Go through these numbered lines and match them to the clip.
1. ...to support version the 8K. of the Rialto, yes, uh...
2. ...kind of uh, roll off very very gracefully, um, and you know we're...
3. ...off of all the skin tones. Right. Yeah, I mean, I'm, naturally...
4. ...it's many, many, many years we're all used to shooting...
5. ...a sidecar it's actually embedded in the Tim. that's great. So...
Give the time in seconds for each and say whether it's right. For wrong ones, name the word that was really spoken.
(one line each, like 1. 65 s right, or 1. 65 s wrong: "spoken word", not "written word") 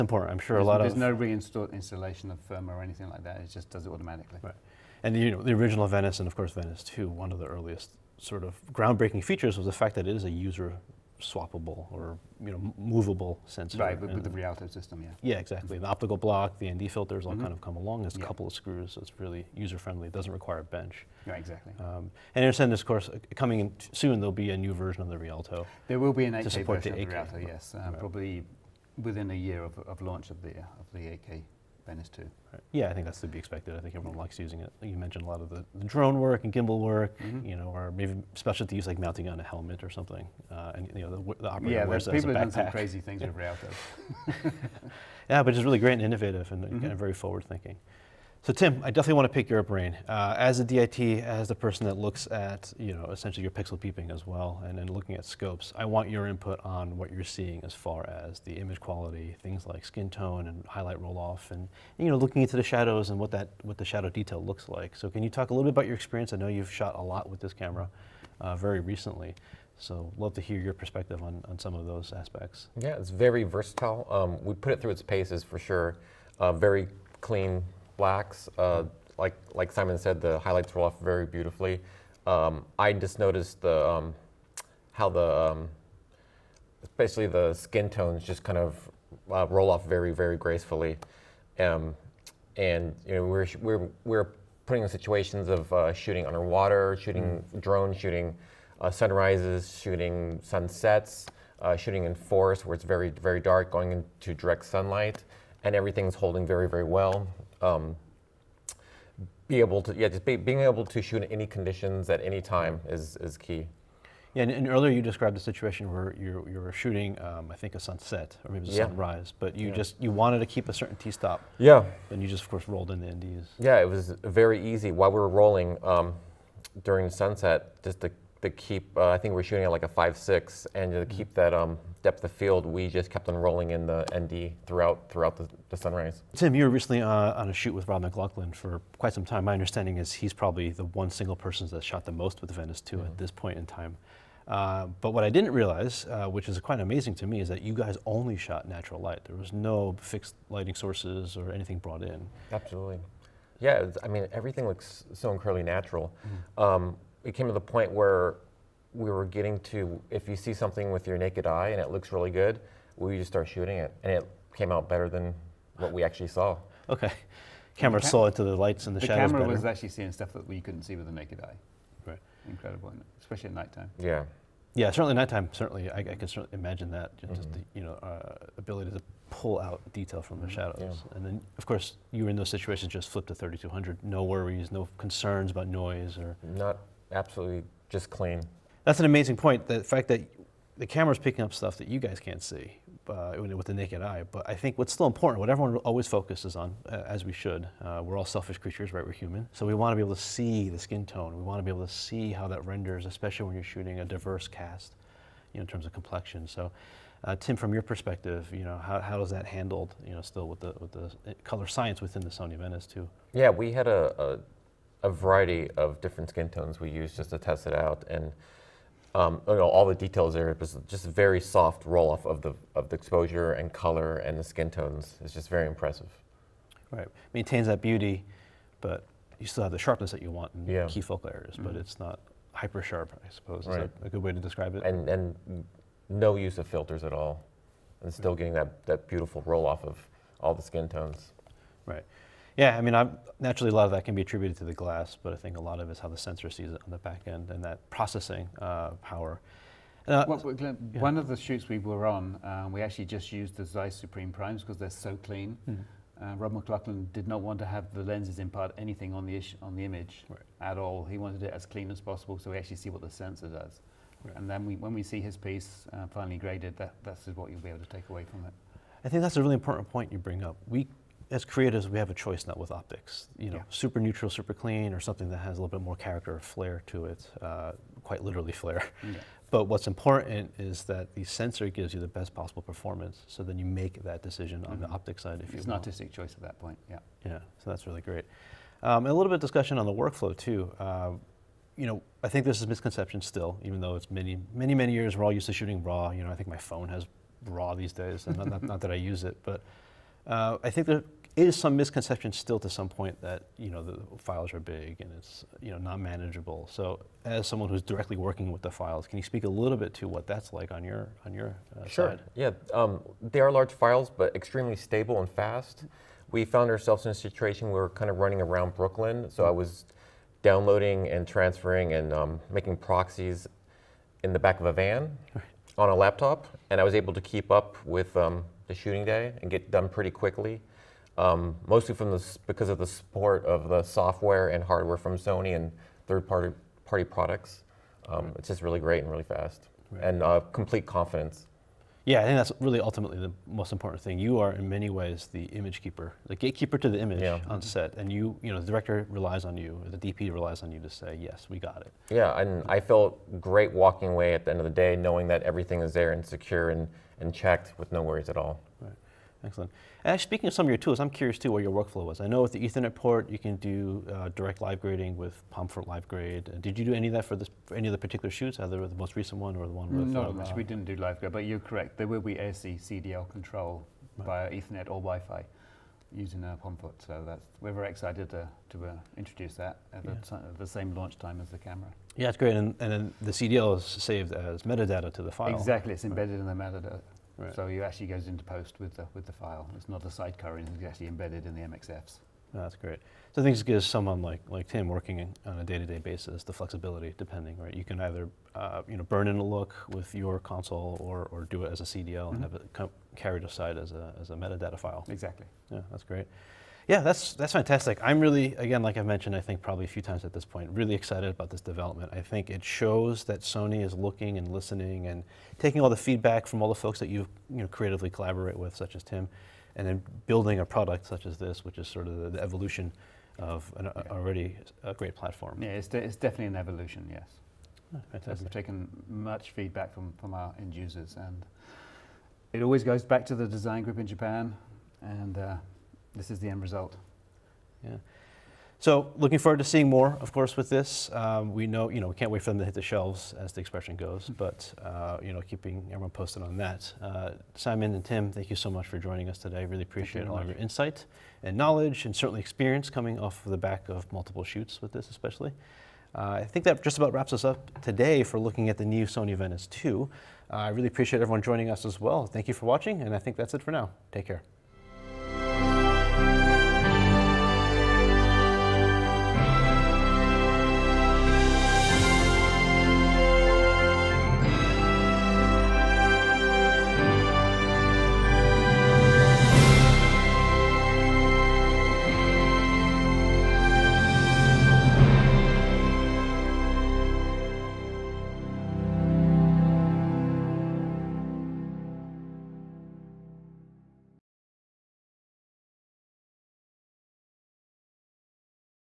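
1. 26 s right
2. 88 s right
3. 239 s right
4. 293 s right
5. 390 s wrong: "MXFs", not "Tim".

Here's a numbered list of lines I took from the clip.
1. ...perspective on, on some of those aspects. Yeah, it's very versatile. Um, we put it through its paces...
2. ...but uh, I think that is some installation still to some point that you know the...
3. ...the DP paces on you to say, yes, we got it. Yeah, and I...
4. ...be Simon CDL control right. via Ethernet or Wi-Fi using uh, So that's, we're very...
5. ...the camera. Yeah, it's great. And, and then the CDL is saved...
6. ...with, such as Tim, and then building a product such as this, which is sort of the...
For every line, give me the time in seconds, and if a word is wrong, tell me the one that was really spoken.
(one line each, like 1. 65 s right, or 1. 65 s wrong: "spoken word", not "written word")
1. 70 s right
2. 299 s wrong: "misconception", not "installation"
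3. 349 s wrong: "relies", not "paces"
4. 372 s wrong: "ASC", not "Simon"
5. 381 s right
6. 418 s right.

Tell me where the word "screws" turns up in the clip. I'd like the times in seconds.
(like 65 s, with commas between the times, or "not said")
18 s.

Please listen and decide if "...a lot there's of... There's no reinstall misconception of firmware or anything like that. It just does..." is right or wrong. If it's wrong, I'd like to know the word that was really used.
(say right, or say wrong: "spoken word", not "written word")
wrong: "installation", not "misconception".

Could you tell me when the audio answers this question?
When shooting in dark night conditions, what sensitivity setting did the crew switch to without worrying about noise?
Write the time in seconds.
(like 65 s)
183 s.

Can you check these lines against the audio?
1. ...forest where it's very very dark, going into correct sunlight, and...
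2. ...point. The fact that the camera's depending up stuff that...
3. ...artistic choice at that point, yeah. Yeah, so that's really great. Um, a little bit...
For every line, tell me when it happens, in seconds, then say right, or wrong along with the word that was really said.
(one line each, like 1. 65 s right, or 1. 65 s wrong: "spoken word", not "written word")
1. 102 s wrong: "direct", not "correct"
2. 189 s wrong: "picking", not "depending"
3. 285 s right.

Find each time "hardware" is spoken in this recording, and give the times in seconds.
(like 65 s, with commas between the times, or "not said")
334 s.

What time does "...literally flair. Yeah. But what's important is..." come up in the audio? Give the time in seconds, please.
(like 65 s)
278 s.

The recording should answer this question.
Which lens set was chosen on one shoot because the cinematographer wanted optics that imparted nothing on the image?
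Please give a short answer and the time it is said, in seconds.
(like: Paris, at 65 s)
Zeiss Supreme Primes, at 253 s.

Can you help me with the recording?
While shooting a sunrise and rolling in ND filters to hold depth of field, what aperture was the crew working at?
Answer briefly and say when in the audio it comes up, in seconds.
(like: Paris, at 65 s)
5.6, at 129 s.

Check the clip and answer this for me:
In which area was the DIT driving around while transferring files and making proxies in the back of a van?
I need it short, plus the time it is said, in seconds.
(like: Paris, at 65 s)
Brooklyn, at 318 s.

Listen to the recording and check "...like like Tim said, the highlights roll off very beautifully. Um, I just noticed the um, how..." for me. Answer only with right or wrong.
wrong.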